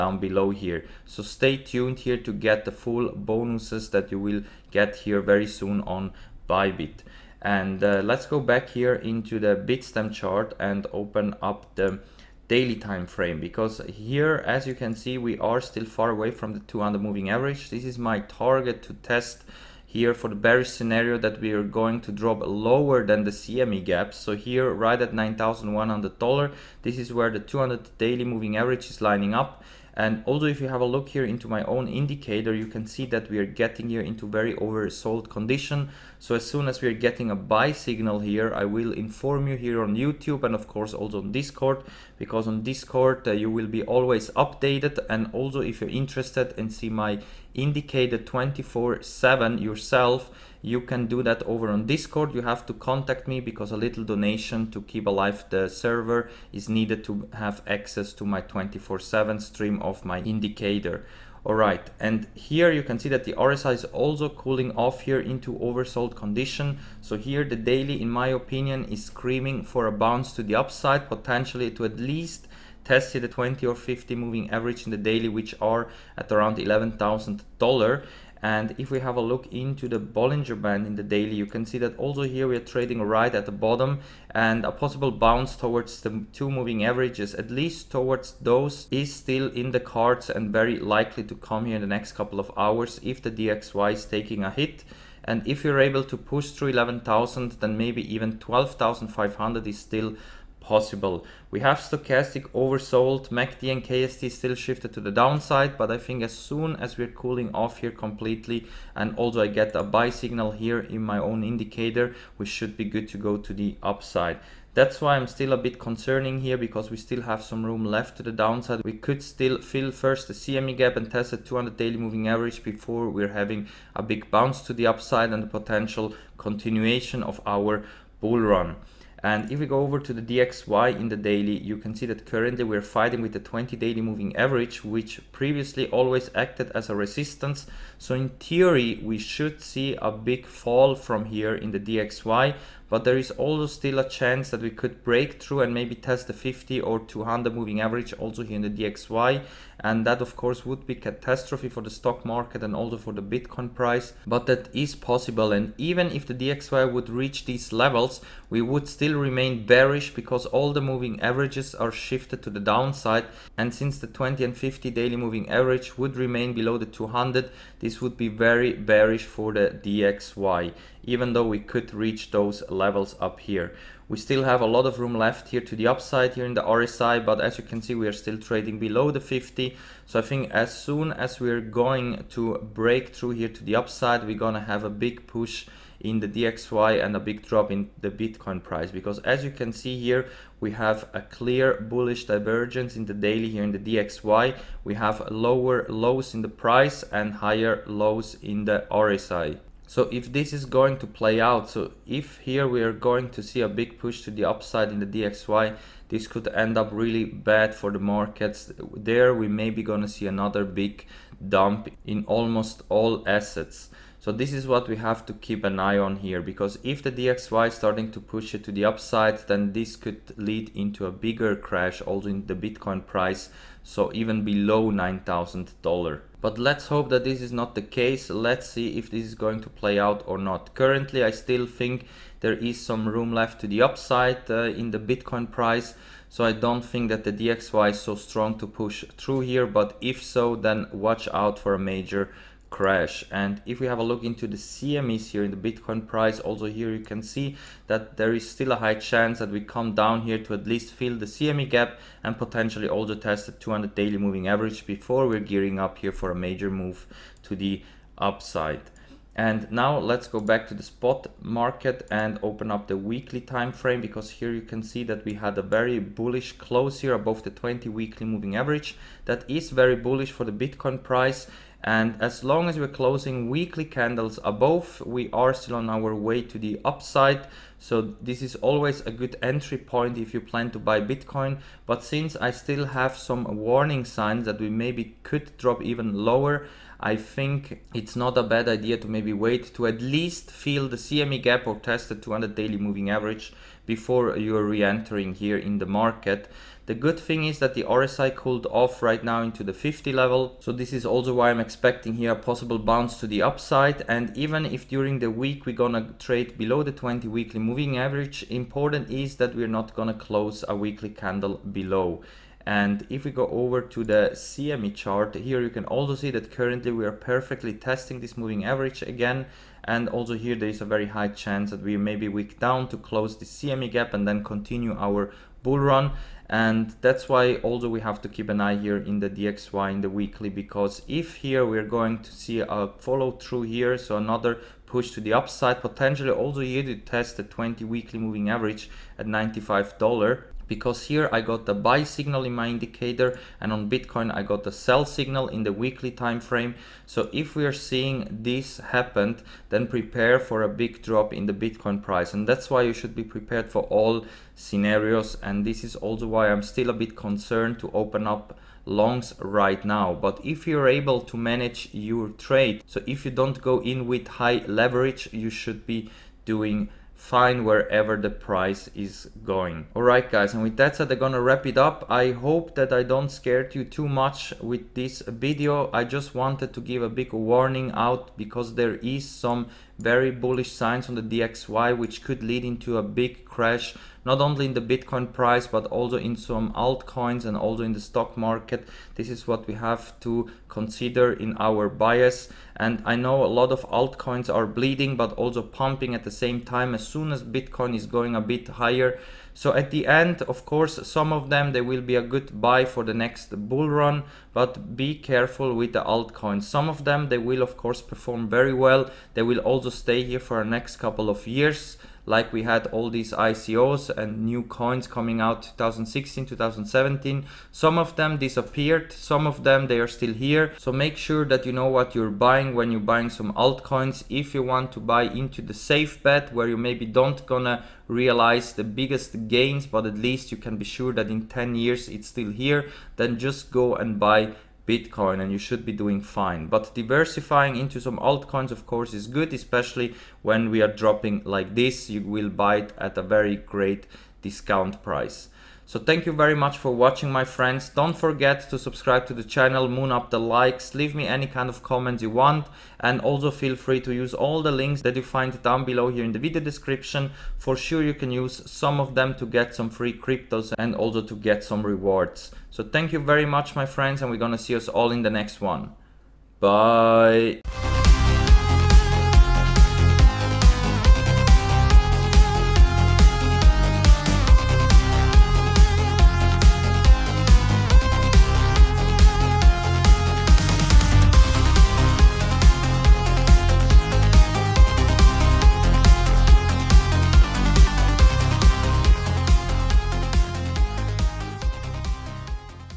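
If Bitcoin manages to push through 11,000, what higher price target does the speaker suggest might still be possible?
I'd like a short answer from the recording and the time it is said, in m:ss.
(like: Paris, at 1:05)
12,500, at 1:38.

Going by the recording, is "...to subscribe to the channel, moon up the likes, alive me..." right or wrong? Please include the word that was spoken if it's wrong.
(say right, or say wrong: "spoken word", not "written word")
wrong: "leave", not "alive".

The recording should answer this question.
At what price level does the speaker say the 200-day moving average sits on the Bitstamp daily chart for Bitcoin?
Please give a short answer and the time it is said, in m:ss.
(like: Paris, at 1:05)
$9,100, at 0:25.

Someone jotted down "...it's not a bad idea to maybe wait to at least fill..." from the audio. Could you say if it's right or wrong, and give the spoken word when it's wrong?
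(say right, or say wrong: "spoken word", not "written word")
right.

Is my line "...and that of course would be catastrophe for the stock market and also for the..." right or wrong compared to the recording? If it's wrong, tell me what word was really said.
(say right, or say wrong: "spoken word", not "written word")
right.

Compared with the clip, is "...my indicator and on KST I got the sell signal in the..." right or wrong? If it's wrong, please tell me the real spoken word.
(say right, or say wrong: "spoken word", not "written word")
wrong: "Bitcoin", not "KST".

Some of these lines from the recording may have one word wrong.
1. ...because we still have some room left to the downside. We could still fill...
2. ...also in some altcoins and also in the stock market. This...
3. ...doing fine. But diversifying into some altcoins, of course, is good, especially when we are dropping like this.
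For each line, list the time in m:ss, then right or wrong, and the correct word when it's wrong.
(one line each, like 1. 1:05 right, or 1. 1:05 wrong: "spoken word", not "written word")
1. 1:56 right
2. 6:25 right
3. 7:15 right.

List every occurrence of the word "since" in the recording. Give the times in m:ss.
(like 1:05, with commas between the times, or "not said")
2:43, 4:42.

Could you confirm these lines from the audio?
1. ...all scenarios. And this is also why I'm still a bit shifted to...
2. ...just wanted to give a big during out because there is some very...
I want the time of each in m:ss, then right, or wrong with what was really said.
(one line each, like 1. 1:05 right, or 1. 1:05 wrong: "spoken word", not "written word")
1. 5:53 wrong: "concerned", not "shifted"
2. 6:16 wrong: "warning", not "during".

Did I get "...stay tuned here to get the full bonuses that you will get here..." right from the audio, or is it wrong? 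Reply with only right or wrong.
right.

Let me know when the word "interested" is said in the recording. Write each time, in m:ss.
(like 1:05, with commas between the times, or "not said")
0:45.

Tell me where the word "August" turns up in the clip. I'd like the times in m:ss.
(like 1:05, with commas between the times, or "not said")
not said.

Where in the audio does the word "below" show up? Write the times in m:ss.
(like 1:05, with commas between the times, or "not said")
0:00, 2:46, 2:58, 3:44, 5:06, 5:11, 7:35.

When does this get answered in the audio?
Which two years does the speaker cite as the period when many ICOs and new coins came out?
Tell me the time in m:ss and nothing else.
6:55.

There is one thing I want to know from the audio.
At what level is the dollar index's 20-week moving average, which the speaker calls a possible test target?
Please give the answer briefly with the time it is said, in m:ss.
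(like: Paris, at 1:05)
95, at 5:39.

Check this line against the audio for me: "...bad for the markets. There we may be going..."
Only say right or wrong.
right.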